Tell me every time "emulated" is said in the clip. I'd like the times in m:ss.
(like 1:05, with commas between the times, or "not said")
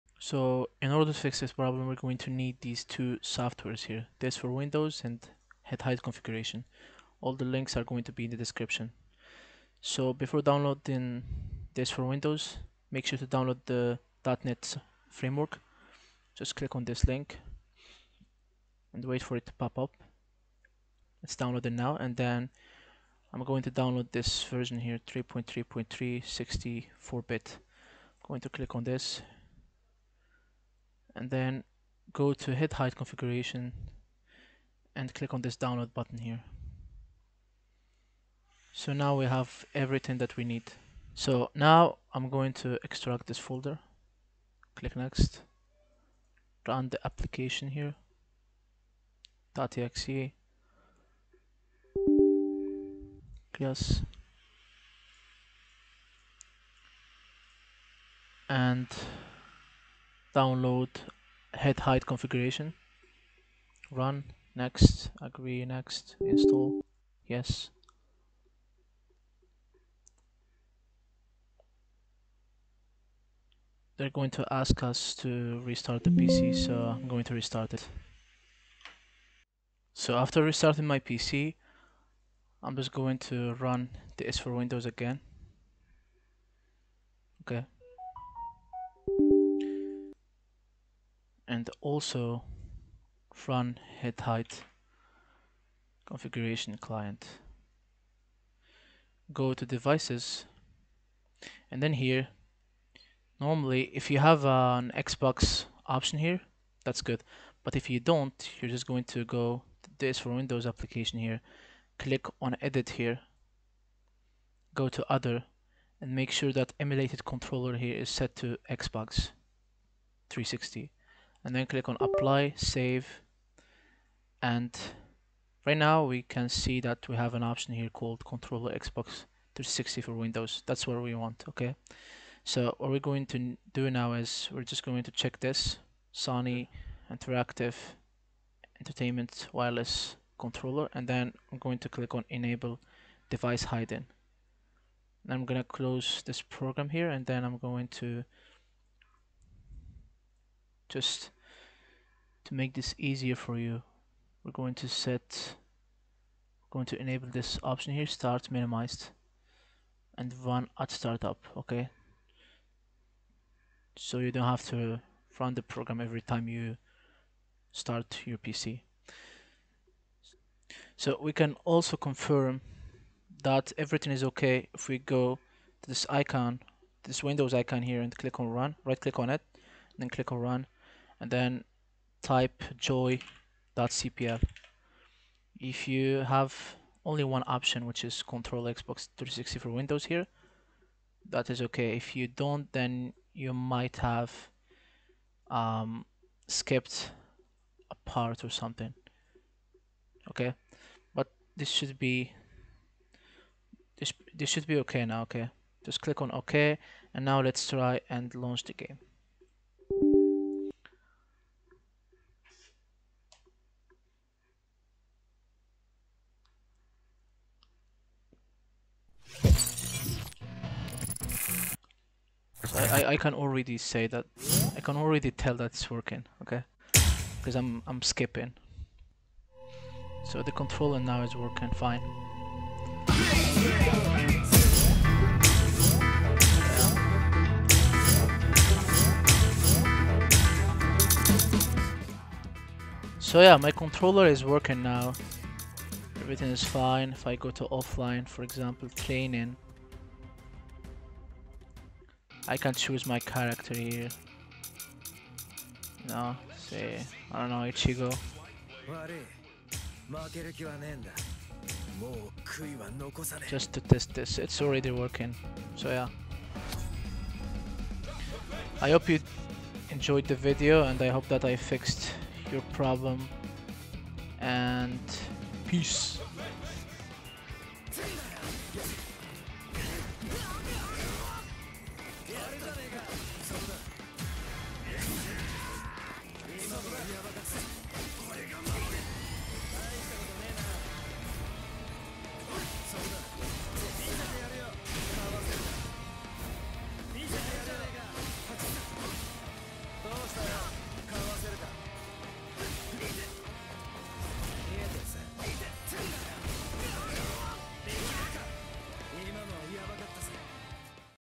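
1:56.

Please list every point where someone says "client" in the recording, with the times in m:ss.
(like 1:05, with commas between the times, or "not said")
1:36.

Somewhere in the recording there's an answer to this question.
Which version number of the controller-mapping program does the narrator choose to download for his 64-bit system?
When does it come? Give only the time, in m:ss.
0:25.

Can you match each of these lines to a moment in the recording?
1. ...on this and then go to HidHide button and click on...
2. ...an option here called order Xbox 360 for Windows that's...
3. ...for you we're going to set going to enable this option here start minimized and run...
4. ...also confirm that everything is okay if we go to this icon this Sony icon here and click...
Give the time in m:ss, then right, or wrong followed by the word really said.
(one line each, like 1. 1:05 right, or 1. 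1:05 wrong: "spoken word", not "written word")
1. 0:28 wrong: "configuration", not "button"
2. 2:07 wrong: "controller", not "order"
3. 2:33 right
4. 2:51 wrong: "Windows", not "Sony".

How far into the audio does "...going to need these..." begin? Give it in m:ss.
0:01.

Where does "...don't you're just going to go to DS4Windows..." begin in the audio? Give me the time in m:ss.
1:47.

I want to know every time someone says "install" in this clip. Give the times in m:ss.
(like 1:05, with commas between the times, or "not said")
1:06.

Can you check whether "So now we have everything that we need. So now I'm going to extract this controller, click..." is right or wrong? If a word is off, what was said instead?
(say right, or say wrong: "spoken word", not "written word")
wrong: "folder", not "controller".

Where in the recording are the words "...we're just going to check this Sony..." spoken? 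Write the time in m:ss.
2:14.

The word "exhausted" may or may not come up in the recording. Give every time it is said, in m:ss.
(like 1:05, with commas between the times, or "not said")
not said.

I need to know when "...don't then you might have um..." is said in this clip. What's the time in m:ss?
3:12.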